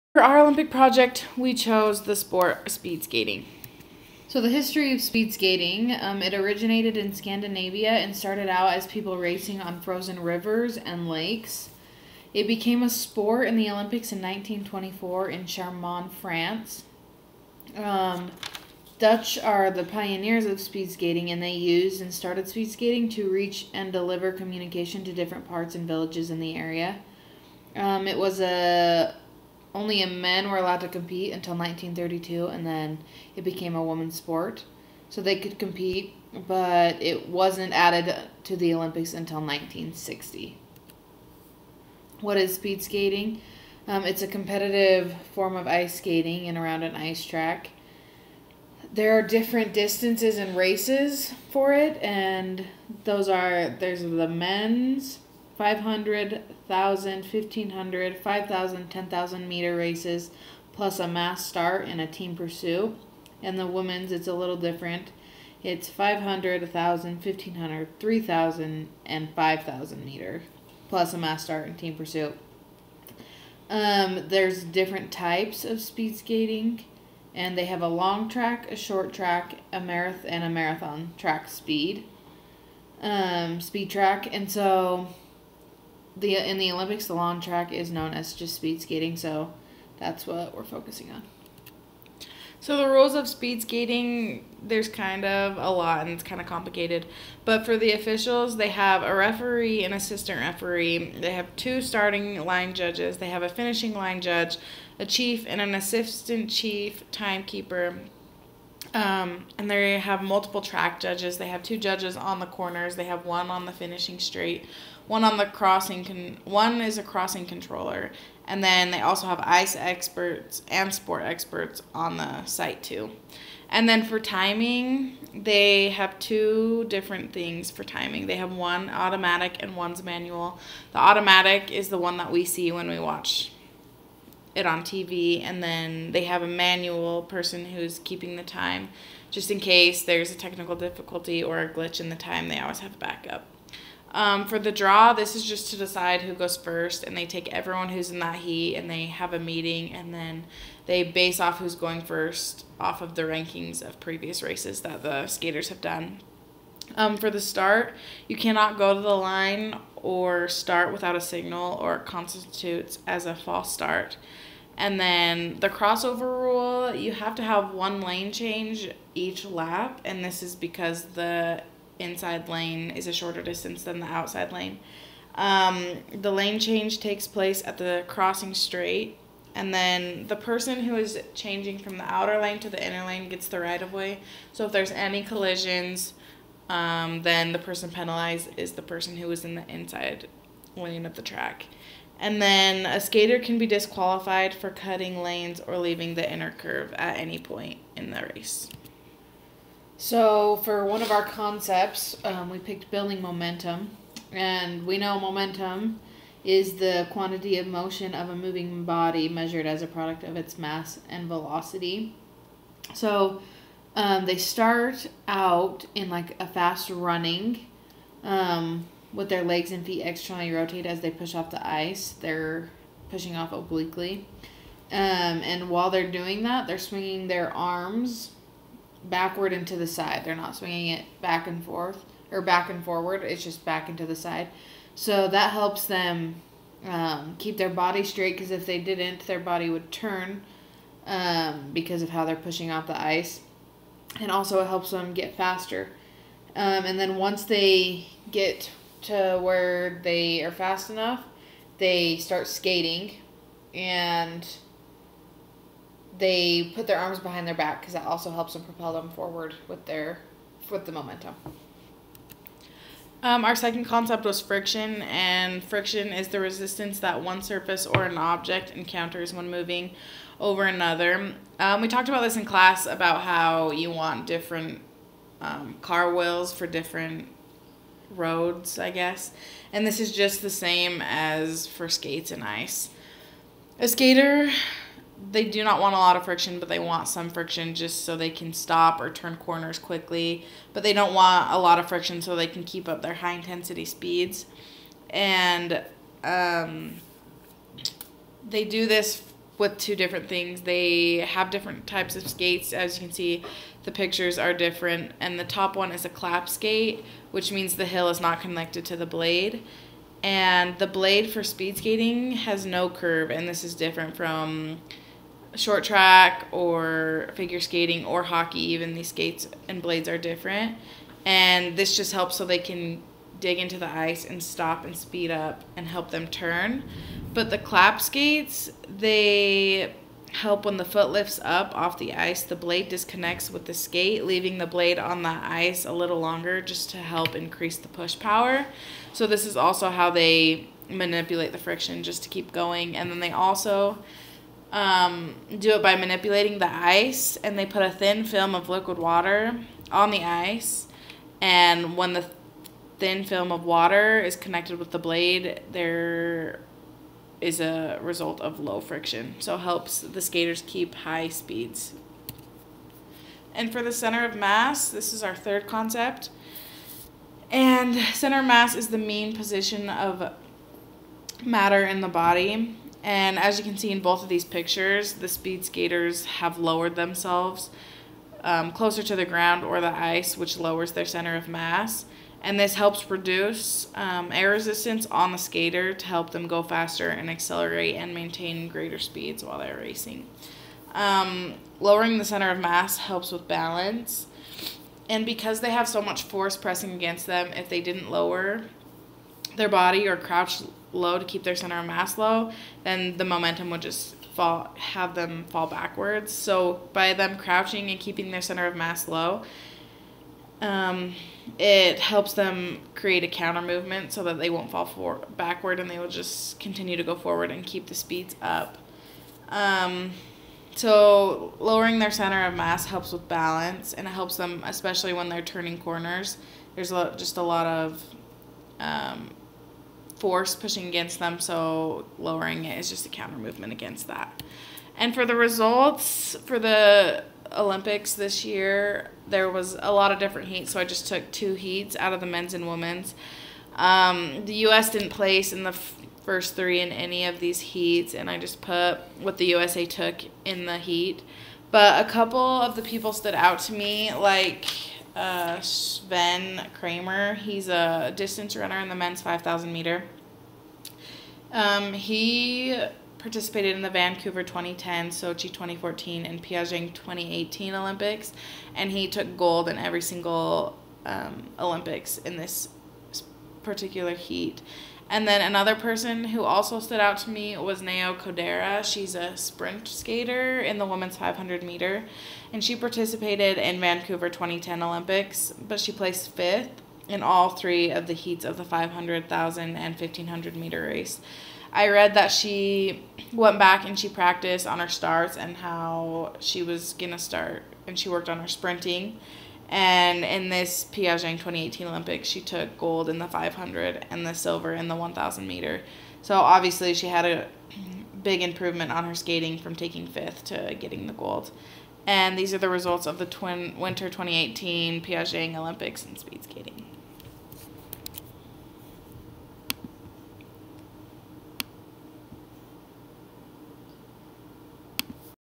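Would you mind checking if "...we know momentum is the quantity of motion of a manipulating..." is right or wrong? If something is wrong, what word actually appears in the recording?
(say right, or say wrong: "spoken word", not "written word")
wrong: "moving", not "manipulating".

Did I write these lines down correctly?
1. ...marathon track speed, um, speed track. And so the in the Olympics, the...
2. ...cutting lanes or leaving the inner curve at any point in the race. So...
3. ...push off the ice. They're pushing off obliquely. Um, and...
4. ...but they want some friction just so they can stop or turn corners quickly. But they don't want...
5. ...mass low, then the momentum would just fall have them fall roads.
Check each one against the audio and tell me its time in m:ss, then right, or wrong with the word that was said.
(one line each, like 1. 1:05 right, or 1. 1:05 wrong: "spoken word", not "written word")
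1. 1:20 right
2. 3:14 right
3. 3:41 right
4. 4:46 right
5. 6:41 wrong: "backwards", not "roads".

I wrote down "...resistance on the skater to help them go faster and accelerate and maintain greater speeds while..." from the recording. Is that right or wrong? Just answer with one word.
right.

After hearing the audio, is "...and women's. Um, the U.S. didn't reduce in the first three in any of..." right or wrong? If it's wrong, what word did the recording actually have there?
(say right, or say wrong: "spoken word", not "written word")
wrong: "place", not "reduce".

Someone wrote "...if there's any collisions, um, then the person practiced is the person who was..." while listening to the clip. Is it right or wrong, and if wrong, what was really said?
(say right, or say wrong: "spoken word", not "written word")
wrong: "penalized", not "practiced".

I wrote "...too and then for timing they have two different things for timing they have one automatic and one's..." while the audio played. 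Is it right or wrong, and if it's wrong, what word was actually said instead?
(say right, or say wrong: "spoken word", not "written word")
right.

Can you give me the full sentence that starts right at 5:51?
And when the thin film of water is connected with the blade, there is a result of low friction.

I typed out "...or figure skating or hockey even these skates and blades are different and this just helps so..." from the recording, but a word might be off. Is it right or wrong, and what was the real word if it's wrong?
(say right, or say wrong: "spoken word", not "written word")
right.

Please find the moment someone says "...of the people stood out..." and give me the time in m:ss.
7:32.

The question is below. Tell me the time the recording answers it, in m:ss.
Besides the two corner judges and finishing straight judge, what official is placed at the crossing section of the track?
1:57.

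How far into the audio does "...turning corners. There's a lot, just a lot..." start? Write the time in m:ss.
7:05.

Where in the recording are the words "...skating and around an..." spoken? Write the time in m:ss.
0:45.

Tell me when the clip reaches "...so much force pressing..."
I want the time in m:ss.
6:35.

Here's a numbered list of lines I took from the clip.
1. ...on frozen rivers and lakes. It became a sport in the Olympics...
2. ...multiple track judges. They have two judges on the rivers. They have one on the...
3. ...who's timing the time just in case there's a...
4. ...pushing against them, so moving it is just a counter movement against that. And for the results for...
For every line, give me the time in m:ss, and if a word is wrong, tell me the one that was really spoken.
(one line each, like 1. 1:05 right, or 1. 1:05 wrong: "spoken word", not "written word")
1. 0:09 right
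2. 1:50 wrong: "corners", not "rivers"
3. 2:17 wrong: "keeping", not "timing"
4. 7:10 wrong: "lowering", not "moving".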